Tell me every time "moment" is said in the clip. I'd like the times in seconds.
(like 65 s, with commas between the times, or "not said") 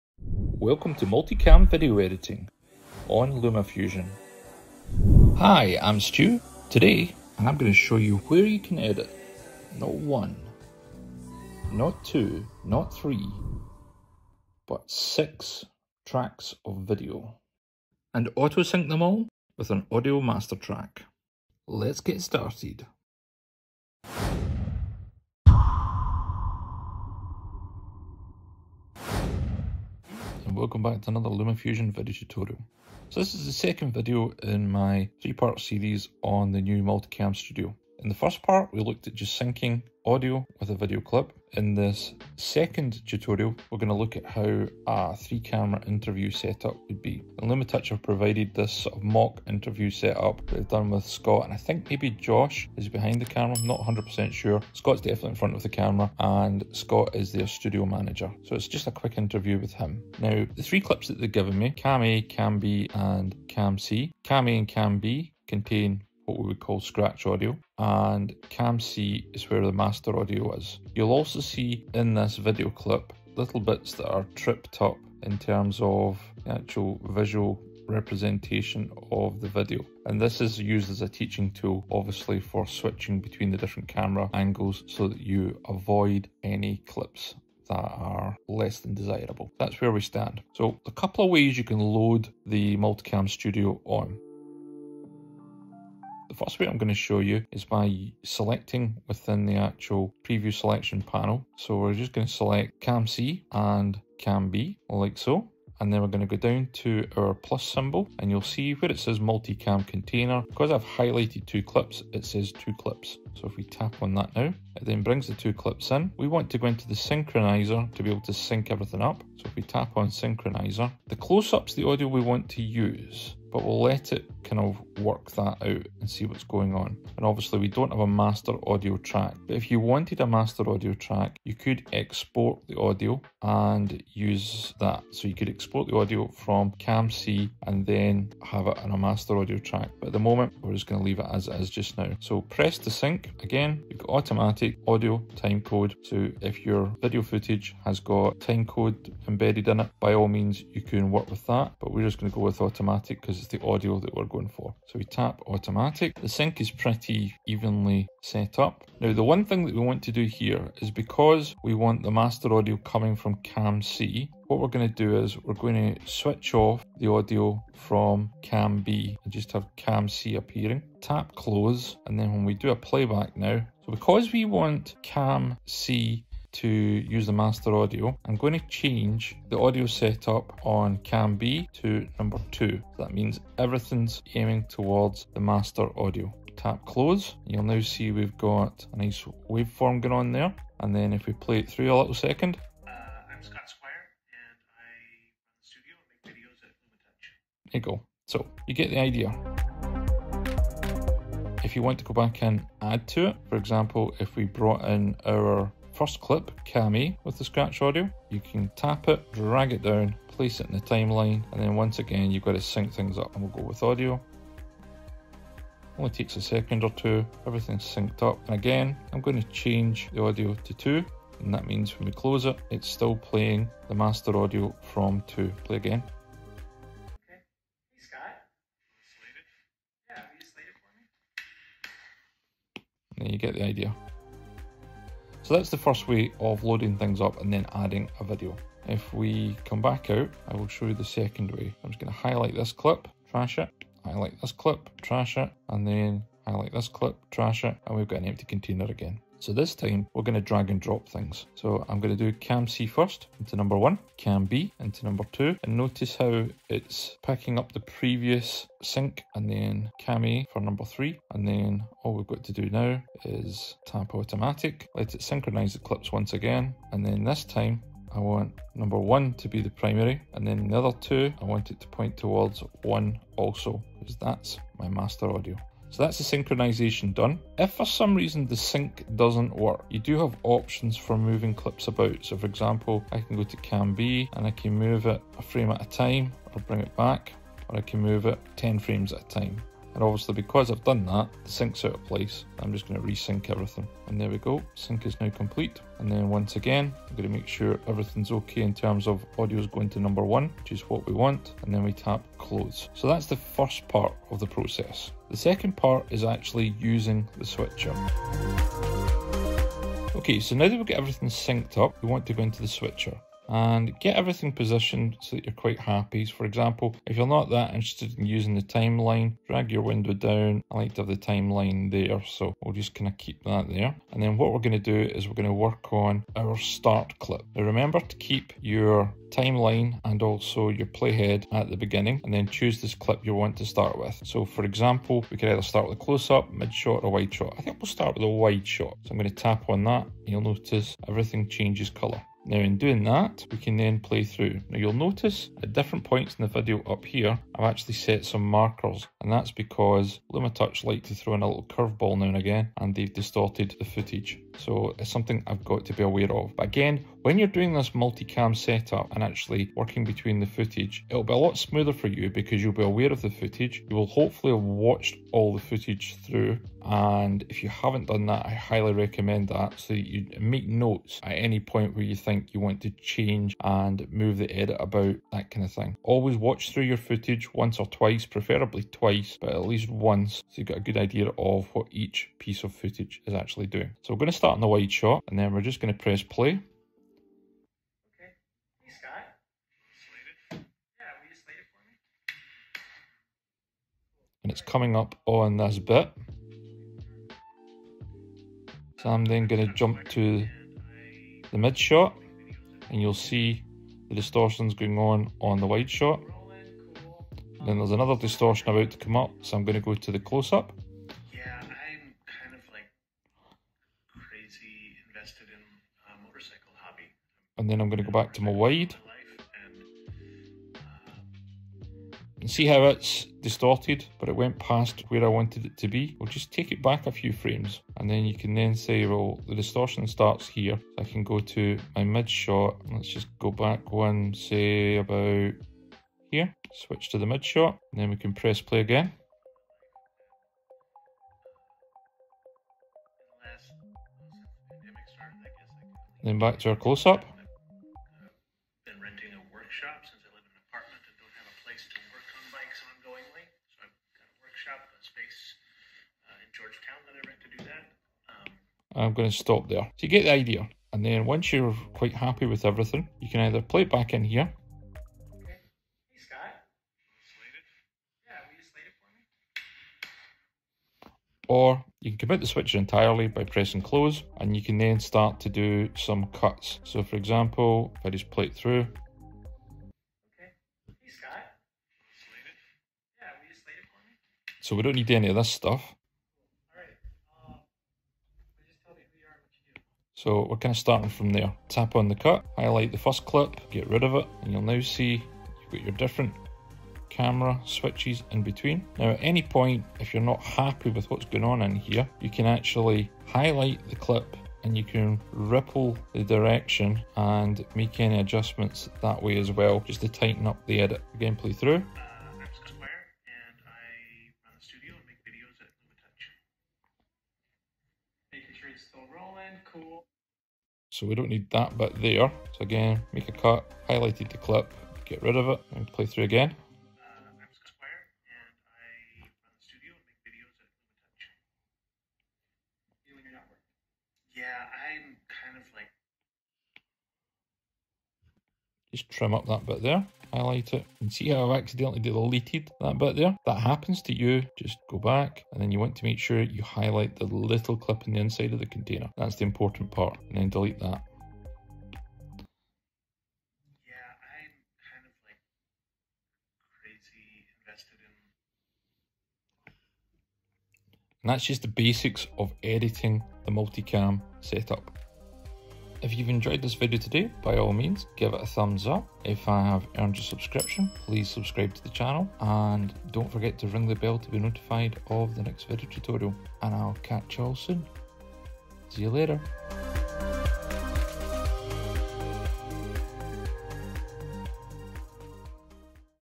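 140 s.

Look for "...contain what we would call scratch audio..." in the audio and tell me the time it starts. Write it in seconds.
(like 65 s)
65 s.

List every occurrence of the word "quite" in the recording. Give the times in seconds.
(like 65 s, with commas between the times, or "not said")
315 s, 461 s.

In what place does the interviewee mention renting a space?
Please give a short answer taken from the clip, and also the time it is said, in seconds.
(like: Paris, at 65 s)
Georgetown, at 456 s.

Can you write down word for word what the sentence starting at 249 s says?
So this time we're going to drag and drop things.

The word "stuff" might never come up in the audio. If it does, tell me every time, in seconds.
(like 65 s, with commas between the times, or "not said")
485 s.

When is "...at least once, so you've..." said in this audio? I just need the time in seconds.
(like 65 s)
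379 s.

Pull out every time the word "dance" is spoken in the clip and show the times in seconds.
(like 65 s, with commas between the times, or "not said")
not said.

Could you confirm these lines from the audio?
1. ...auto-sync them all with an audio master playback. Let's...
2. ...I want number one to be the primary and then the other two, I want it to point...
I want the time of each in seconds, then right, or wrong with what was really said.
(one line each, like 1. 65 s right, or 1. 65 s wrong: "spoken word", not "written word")
1. 18 s wrong: "track", not "playback"
2. 268 s right.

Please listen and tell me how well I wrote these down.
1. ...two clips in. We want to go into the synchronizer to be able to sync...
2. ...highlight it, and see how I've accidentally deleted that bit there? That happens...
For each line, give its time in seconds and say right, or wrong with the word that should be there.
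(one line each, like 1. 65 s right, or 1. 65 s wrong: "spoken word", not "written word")
1. 115 s right
2. 540 s right.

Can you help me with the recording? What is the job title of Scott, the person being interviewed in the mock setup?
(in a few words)
Studio manager.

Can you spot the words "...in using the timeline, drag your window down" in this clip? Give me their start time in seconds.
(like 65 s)
318 s.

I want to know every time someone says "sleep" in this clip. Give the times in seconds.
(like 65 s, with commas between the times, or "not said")
not said.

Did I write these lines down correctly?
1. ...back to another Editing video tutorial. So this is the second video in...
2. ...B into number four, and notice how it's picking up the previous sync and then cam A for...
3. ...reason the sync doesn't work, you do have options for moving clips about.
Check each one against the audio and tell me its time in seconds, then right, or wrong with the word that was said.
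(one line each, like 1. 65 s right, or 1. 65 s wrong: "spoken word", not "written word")
1. 30 s wrong: "LumaFusion", not "Editing"
2. 254 s wrong: "two", not "four"
3. 278 s right.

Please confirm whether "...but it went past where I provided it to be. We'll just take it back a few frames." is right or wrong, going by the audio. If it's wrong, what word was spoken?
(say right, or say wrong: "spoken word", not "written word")
wrong: "wanted", not "provided".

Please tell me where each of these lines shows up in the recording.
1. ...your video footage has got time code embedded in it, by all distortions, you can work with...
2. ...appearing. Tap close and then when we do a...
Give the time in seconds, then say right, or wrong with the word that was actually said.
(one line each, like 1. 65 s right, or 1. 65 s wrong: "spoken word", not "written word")
1. 146 s wrong: "means", not "distortions"
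2. 170 s right.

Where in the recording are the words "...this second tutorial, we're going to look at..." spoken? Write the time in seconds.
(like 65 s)
41 s.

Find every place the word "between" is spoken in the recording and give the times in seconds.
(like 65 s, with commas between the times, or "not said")
83 s, 360 s, 498 s.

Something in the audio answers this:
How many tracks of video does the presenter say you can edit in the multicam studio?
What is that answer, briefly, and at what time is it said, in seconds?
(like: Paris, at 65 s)
6, at 14 s.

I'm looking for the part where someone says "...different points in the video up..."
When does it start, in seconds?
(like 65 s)
345 s.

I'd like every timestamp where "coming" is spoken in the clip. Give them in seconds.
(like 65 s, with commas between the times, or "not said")
162 s, 394 s.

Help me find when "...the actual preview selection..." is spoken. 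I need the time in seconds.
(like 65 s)
99 s.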